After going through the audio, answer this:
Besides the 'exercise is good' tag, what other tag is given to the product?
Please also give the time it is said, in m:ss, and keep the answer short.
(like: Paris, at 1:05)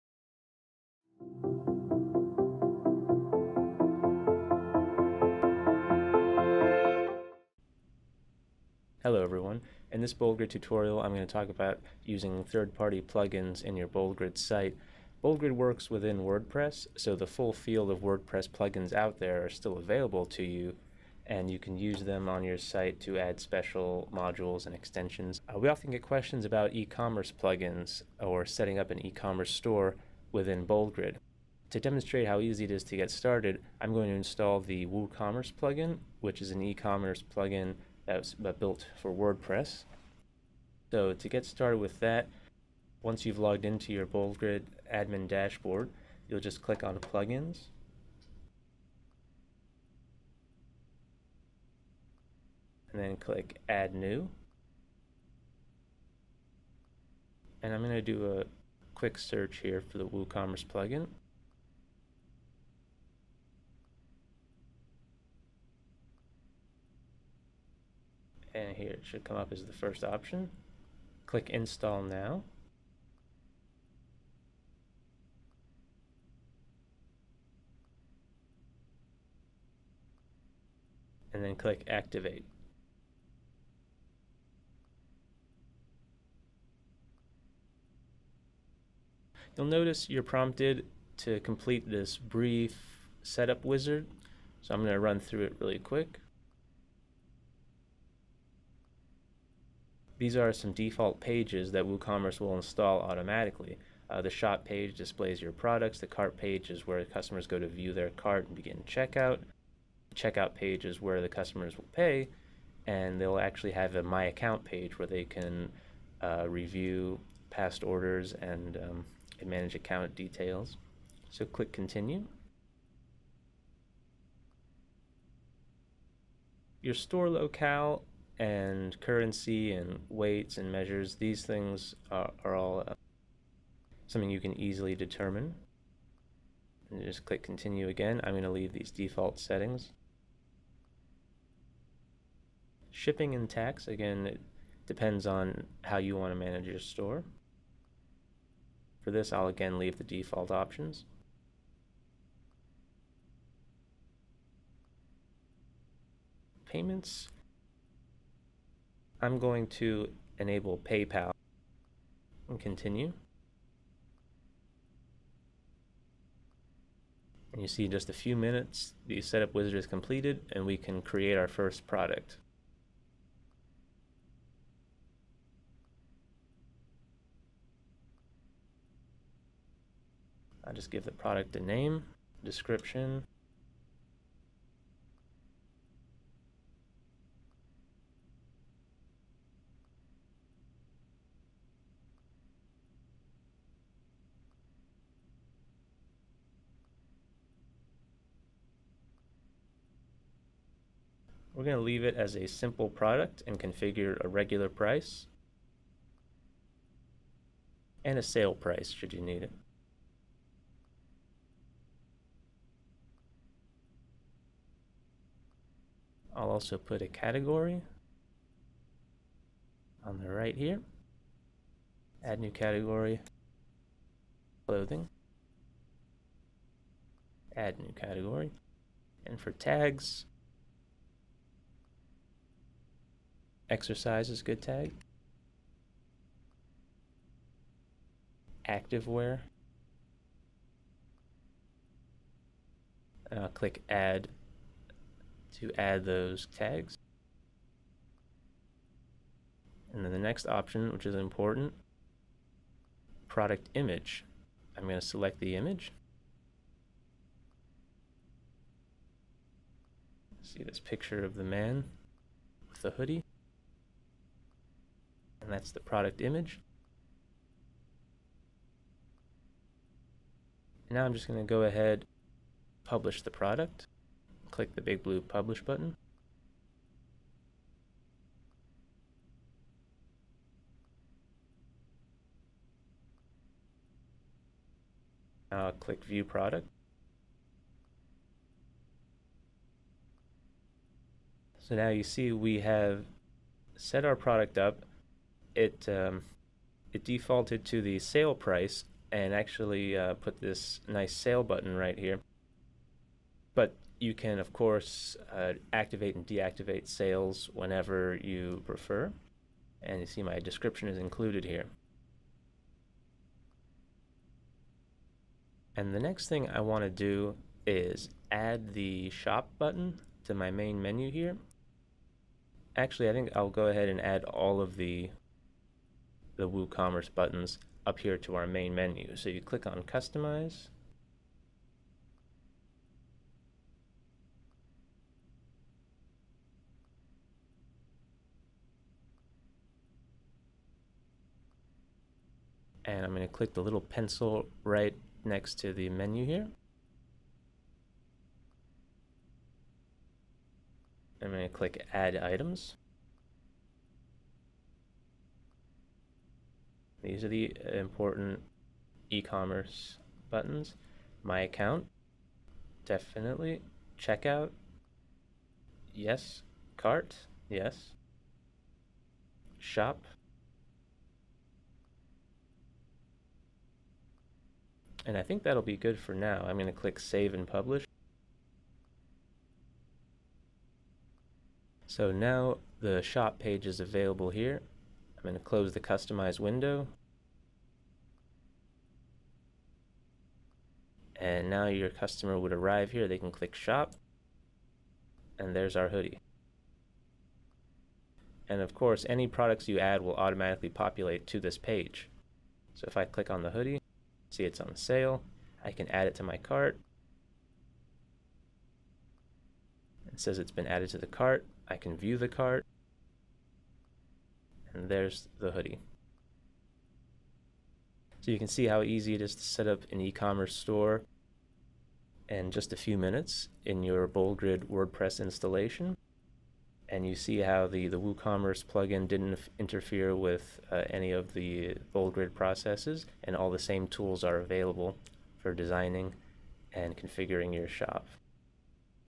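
Activewear, at 3:58.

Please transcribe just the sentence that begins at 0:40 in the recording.
So to get started with that, once you've logged into your BoldGrid admin dashboard, you'll just click on Plugins.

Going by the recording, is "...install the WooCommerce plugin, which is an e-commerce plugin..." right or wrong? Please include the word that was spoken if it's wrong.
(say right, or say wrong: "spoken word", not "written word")
right.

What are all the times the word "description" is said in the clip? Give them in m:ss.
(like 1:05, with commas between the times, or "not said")
3:02, 5:10.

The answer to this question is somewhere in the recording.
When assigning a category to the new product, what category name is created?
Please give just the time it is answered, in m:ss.
3:44.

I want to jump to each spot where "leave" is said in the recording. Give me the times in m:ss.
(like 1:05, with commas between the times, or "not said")
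2:18, 2:29, 3:21.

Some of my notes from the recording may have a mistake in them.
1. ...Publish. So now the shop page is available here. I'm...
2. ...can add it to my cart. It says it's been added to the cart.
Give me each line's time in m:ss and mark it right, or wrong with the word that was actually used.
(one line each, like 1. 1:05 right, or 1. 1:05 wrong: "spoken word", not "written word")
1. 6:17 right
2. 6:45 right.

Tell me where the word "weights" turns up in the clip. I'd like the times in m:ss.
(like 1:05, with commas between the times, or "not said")
2:10.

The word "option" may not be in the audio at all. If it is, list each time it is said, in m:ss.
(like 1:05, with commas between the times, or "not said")
1:10, 2:30, 4:10.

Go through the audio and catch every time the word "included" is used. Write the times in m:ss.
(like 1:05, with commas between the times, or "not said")
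5:10.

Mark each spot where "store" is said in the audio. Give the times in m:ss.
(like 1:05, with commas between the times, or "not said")
0:29, 2:06, 2:26, 7:00.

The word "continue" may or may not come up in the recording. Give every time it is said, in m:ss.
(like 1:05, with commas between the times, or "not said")
2:01, 2:17, 2:42.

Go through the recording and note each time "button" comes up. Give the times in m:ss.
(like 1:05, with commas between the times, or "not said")
4:35, 5:01, 5:19, 5:27, 6:00.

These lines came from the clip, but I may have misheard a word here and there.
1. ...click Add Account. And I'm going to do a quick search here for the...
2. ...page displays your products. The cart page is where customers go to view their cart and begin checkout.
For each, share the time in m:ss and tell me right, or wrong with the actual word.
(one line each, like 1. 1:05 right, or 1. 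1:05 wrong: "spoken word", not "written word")
1. 0:53 wrong: "New", not "Account"
2. 1:44 right.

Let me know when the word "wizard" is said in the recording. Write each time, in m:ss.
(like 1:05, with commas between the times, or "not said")
1:33, 2:49.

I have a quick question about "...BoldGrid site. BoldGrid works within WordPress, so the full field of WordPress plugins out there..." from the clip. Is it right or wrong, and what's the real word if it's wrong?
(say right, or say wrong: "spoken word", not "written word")
right.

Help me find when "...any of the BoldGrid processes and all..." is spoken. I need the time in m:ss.
7:10.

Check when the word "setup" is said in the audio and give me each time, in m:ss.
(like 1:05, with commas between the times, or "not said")
1:33, 2:49.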